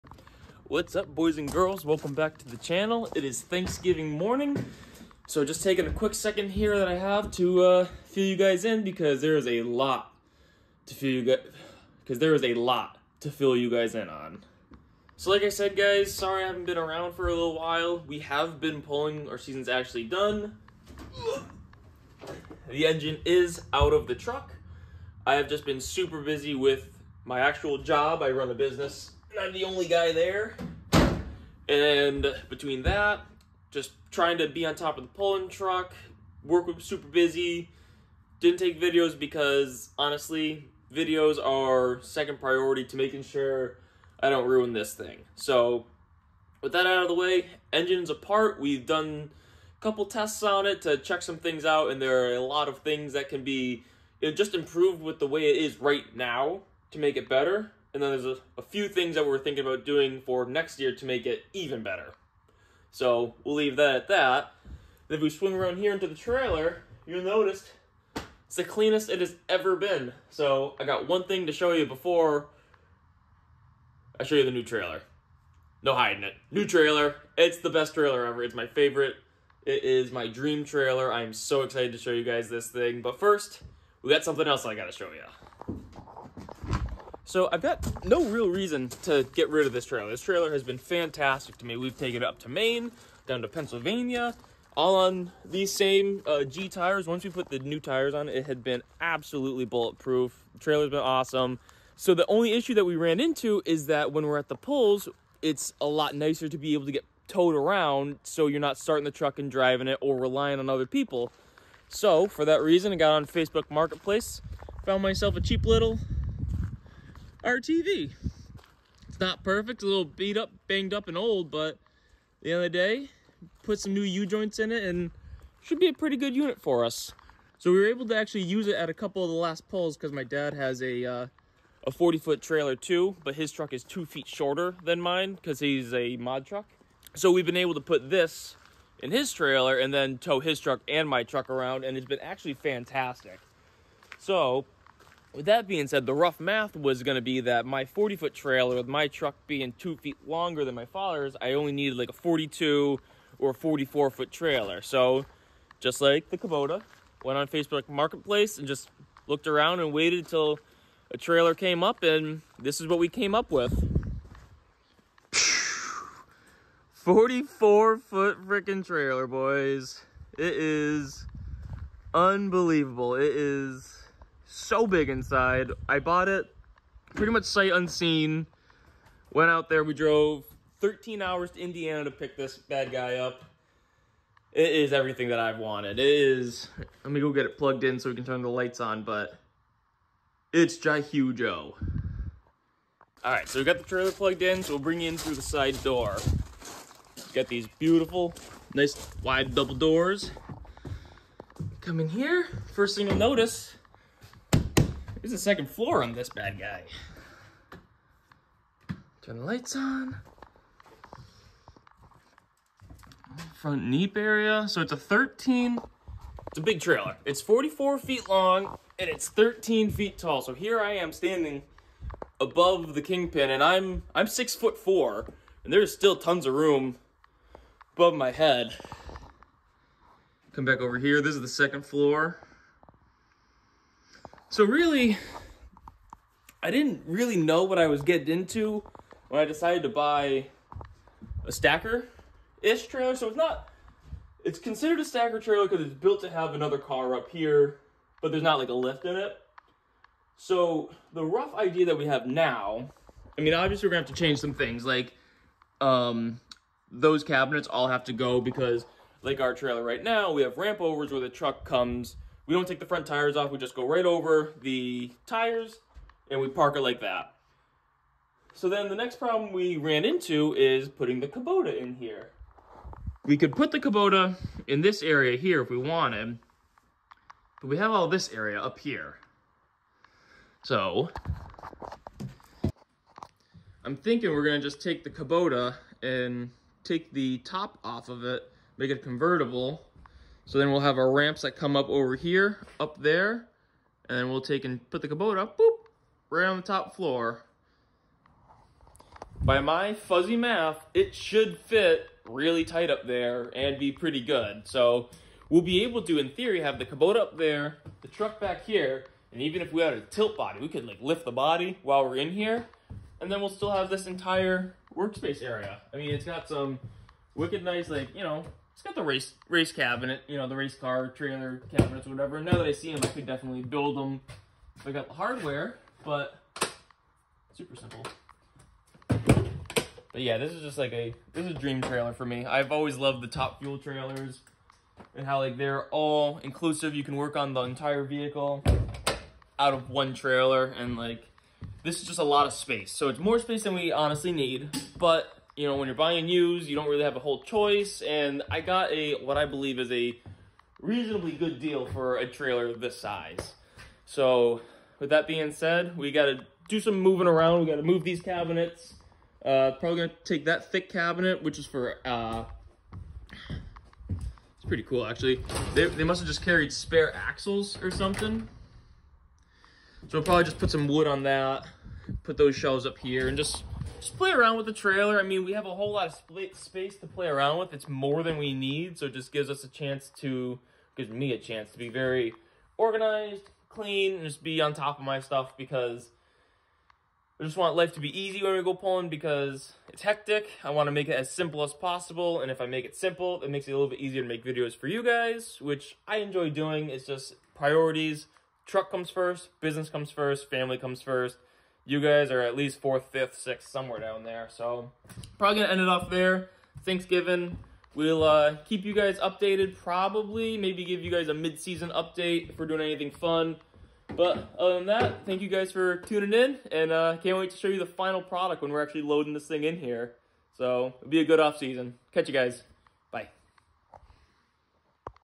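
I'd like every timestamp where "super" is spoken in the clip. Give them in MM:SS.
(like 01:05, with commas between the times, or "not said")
00:25, 00:36, 05:27.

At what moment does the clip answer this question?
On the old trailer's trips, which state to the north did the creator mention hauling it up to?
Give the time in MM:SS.
01:32.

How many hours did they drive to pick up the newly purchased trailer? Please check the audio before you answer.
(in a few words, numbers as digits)
13.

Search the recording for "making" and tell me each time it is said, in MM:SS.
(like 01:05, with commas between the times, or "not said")
00:42.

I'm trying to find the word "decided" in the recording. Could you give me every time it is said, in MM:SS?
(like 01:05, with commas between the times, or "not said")
03:59.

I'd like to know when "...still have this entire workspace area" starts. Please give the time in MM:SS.
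05:13.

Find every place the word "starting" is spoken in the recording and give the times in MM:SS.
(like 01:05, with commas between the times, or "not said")
01:48.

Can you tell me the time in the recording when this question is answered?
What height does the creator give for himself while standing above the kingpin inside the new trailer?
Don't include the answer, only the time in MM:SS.
03:44.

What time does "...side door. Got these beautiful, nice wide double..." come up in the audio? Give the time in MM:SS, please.
03:15.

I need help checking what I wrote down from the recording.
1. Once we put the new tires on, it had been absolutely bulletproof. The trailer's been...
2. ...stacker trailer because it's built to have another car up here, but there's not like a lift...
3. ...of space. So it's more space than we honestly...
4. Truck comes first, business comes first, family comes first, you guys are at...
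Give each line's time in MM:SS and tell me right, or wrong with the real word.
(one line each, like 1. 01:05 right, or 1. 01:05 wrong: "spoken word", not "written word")
1. 01:37 right
2. 04:05 right
3. 05:42 right
4. 06:38 right.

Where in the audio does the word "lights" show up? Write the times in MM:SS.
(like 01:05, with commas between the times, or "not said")
03:08, 03:29.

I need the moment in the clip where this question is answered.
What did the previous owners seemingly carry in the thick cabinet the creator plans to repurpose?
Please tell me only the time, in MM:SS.
06:06.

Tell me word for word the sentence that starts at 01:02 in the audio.
So we'll leave that at that.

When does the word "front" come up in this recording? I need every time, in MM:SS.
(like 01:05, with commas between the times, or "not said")
03:33, 04:22.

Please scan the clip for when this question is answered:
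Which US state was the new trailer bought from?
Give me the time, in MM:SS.
03:01.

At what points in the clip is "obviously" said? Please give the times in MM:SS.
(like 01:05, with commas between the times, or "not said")
04:13.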